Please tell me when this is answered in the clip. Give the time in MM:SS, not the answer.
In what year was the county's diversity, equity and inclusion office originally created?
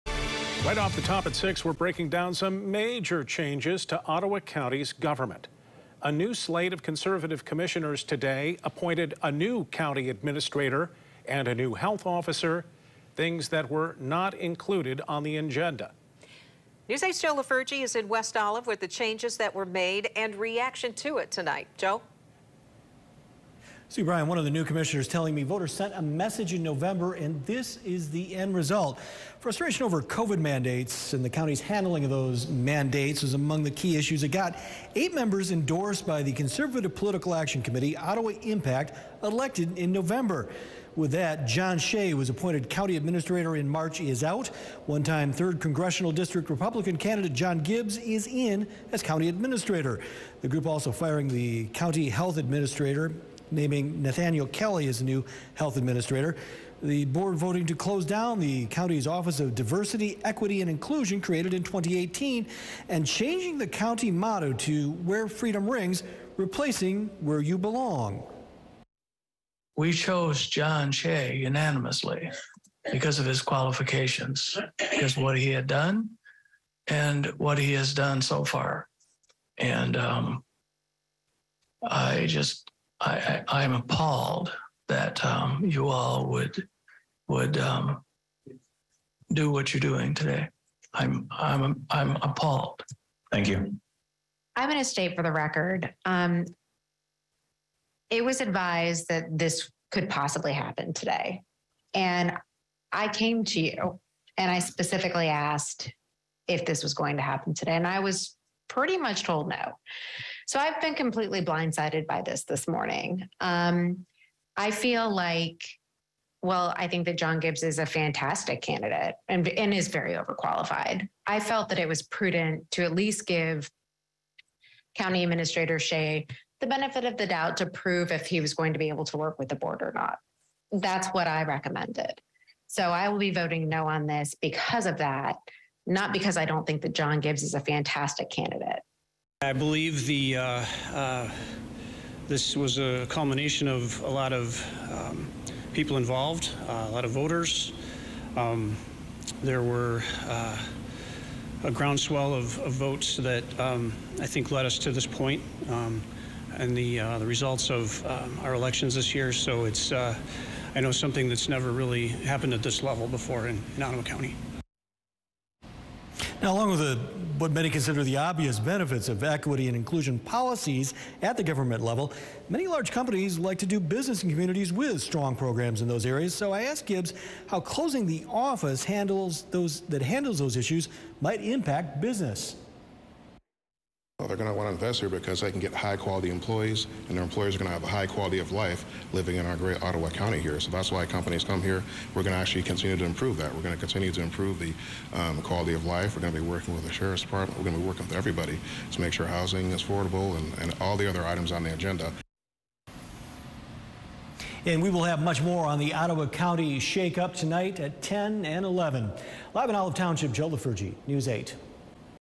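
01:01.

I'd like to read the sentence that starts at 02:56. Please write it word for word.
So I asked Gibbs how closing the office handles those that handles those issues might impact business.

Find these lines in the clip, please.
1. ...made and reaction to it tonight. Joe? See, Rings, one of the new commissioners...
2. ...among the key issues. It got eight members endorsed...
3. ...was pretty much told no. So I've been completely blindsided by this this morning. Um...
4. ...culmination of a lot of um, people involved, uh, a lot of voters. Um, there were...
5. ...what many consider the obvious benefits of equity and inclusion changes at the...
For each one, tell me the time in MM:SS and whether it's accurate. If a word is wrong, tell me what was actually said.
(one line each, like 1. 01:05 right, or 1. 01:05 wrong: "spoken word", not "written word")
1. 00:19 wrong: "Brian", not "Rings"
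2. 00:33 right
3. 01:47 right
4. 02:23 right
5. 02:47 wrong: "policies", not "changes".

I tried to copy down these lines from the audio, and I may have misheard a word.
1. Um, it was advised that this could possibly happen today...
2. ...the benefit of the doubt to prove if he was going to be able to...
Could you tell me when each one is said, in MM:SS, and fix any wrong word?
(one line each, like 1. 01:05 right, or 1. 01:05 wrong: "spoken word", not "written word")
1. 01:36 right
2. 02:06 right.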